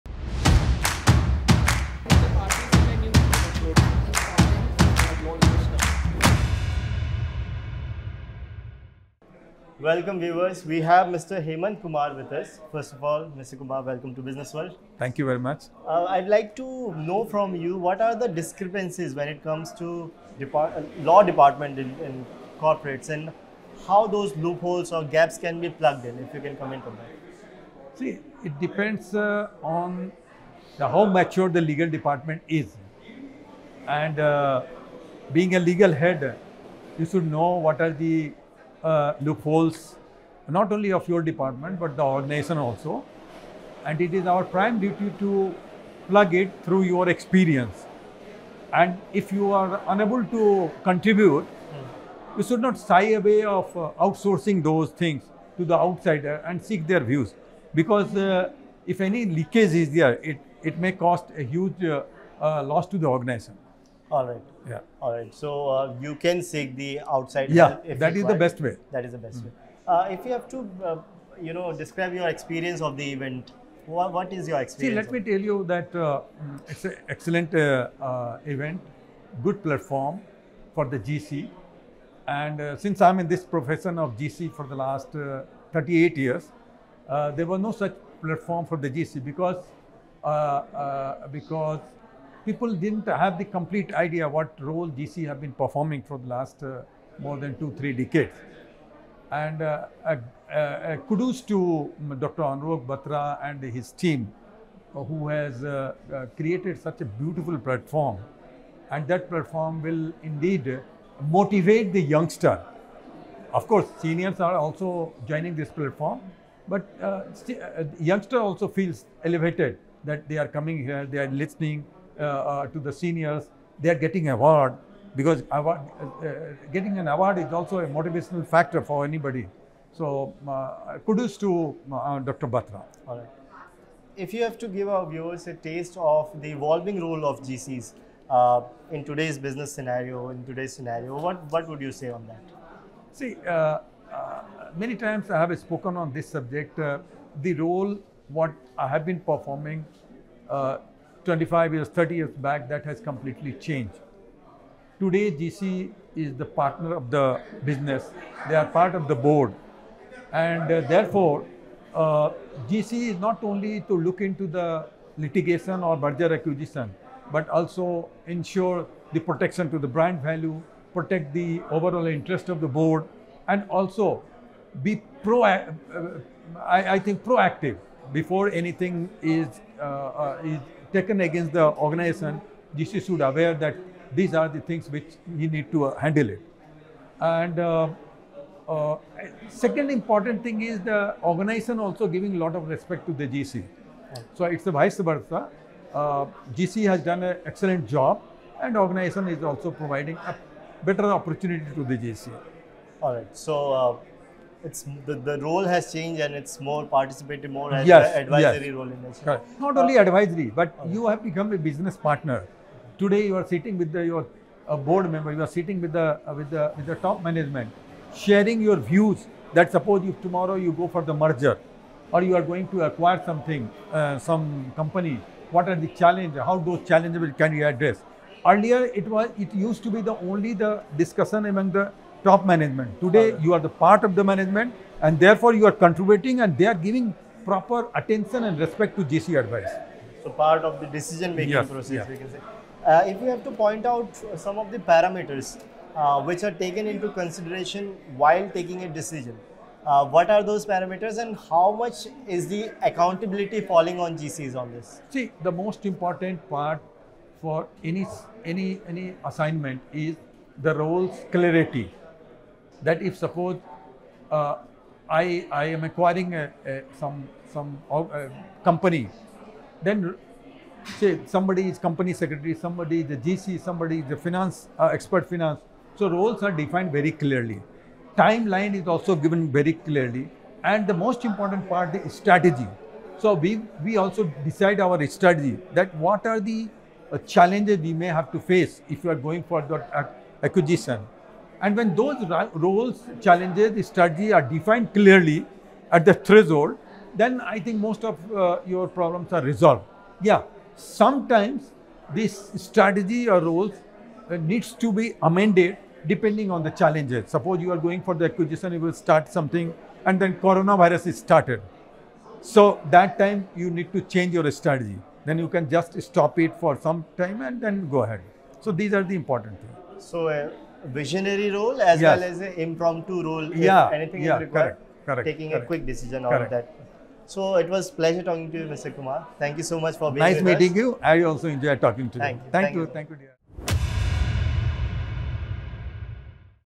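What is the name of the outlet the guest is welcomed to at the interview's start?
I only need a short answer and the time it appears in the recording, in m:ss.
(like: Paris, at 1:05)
Businessworld, at 0:14.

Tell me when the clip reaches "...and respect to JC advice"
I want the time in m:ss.
3:58.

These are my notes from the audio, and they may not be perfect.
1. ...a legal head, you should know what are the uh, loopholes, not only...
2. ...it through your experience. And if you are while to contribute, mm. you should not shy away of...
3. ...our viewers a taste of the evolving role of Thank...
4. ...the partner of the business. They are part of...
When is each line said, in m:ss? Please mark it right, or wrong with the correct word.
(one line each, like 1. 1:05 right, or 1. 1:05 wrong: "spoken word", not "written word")
1. 0:35 right
2. 0:46 wrong: "unable", not "while"
3. 2:14 wrong: "GCs", not "Thank"
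4. 2:36 right.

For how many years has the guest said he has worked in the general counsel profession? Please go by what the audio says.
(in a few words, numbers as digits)
38 years.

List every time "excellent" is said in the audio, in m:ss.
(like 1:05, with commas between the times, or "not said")
1:17, 3:17.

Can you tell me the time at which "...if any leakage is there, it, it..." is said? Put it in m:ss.
0:58.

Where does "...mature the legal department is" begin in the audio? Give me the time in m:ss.
0:31.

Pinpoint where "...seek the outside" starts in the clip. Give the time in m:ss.
1:06.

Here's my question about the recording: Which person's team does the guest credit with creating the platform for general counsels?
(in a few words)
Dr. Anurag Batra.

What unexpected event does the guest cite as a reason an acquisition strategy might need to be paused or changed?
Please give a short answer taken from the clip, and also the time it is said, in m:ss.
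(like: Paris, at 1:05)
coronavirus, at 5:10.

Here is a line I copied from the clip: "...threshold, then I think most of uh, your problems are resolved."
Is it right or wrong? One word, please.
right.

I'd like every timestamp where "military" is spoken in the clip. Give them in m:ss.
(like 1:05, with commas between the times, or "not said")
not said.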